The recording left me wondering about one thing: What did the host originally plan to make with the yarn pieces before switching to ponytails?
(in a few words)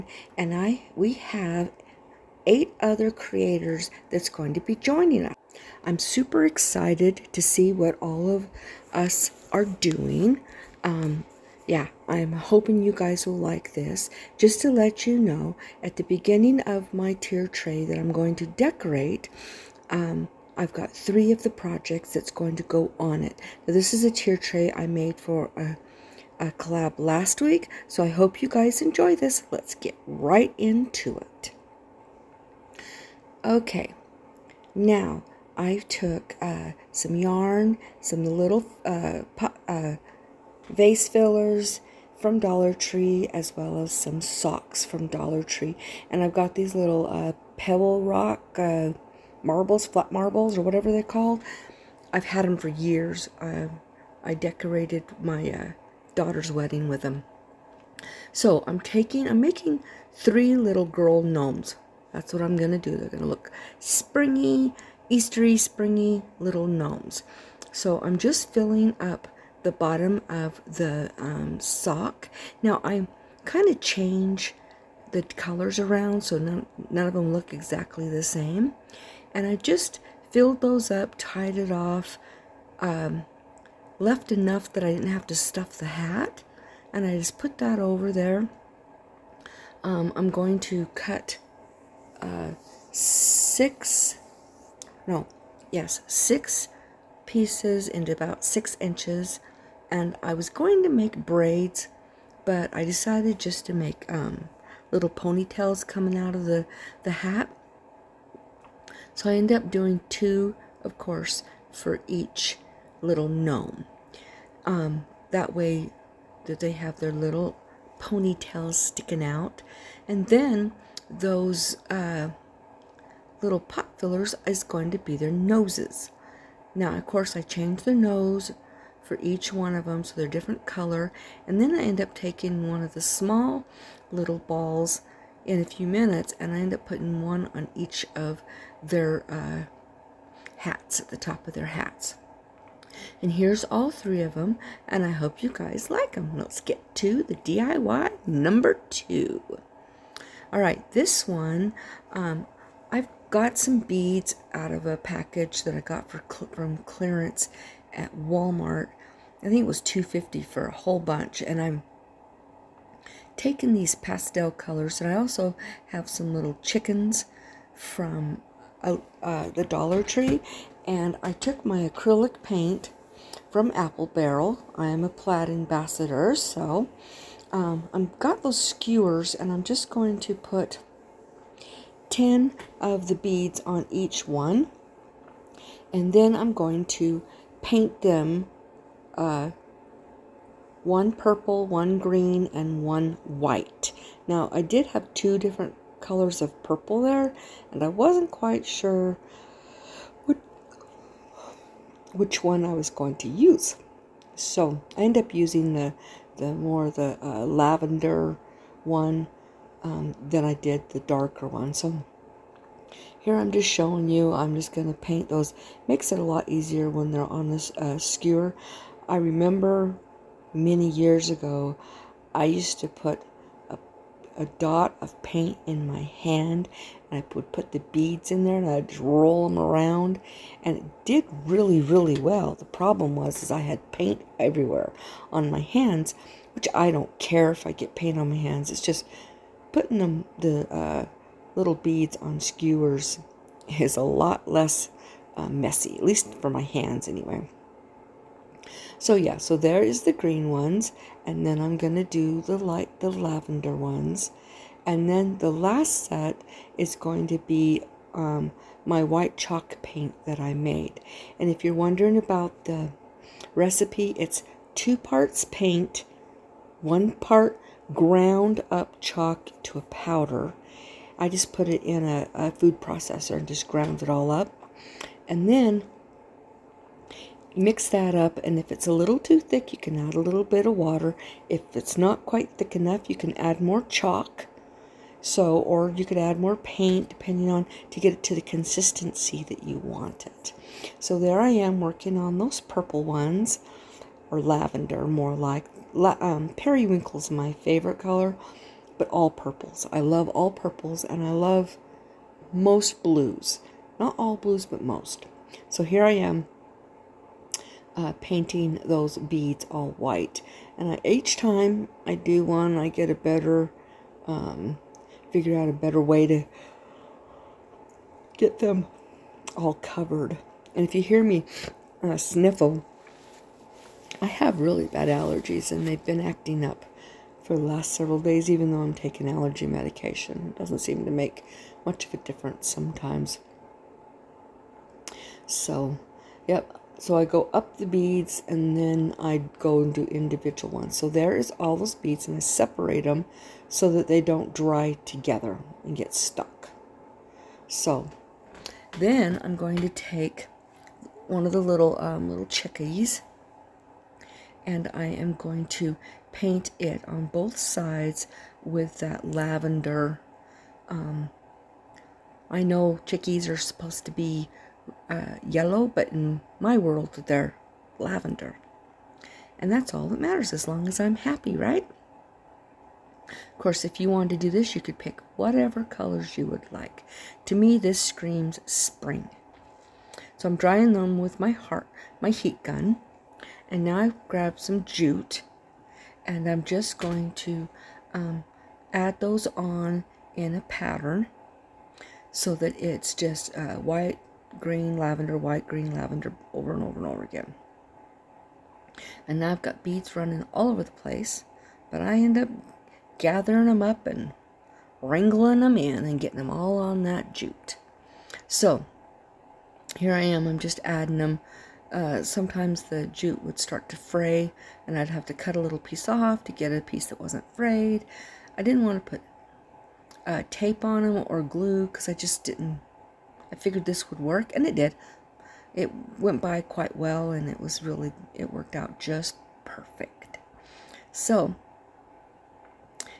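Braids.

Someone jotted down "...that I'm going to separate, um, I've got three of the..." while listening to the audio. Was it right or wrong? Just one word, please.
wrong.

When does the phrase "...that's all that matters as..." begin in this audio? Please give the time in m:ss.
6:09.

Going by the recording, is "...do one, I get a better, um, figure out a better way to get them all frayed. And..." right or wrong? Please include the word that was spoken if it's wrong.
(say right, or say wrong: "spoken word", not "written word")
wrong: "covered", not "frayed".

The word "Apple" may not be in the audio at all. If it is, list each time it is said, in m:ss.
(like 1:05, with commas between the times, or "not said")
2:53.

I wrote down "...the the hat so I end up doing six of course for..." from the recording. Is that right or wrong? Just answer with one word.
wrong.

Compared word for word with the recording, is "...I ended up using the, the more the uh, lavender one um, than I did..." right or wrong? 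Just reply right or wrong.
right.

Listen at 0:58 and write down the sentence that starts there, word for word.
So I'm taking, I'm making three little girl gnomes.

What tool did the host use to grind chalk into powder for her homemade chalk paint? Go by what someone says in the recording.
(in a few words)
Food processor.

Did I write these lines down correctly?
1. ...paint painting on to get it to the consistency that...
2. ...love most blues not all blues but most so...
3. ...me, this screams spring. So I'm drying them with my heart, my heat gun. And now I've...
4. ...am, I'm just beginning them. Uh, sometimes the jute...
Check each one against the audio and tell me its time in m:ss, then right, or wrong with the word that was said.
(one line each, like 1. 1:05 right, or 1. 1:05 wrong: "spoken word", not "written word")
1. 4:46 wrong: "depending", not "painting"
2. 5:01 right
3. 6:17 right
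4. 6:50 wrong: "adding", not "beginning".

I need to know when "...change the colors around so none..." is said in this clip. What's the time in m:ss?
1:13.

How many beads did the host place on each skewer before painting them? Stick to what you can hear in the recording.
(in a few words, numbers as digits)
10.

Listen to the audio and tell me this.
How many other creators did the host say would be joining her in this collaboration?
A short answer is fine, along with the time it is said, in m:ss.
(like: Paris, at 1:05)
8, at 0:02.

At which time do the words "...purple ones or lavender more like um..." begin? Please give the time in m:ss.
4:52.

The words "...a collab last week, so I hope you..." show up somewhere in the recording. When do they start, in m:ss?
0:26.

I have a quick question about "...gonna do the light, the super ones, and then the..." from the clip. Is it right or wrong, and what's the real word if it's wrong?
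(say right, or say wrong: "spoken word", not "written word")
wrong: "lavender", not "super".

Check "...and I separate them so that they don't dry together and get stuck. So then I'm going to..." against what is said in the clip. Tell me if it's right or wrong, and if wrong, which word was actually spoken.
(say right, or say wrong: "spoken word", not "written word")
right.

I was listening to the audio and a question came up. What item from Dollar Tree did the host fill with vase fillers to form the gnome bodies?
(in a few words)
Socks.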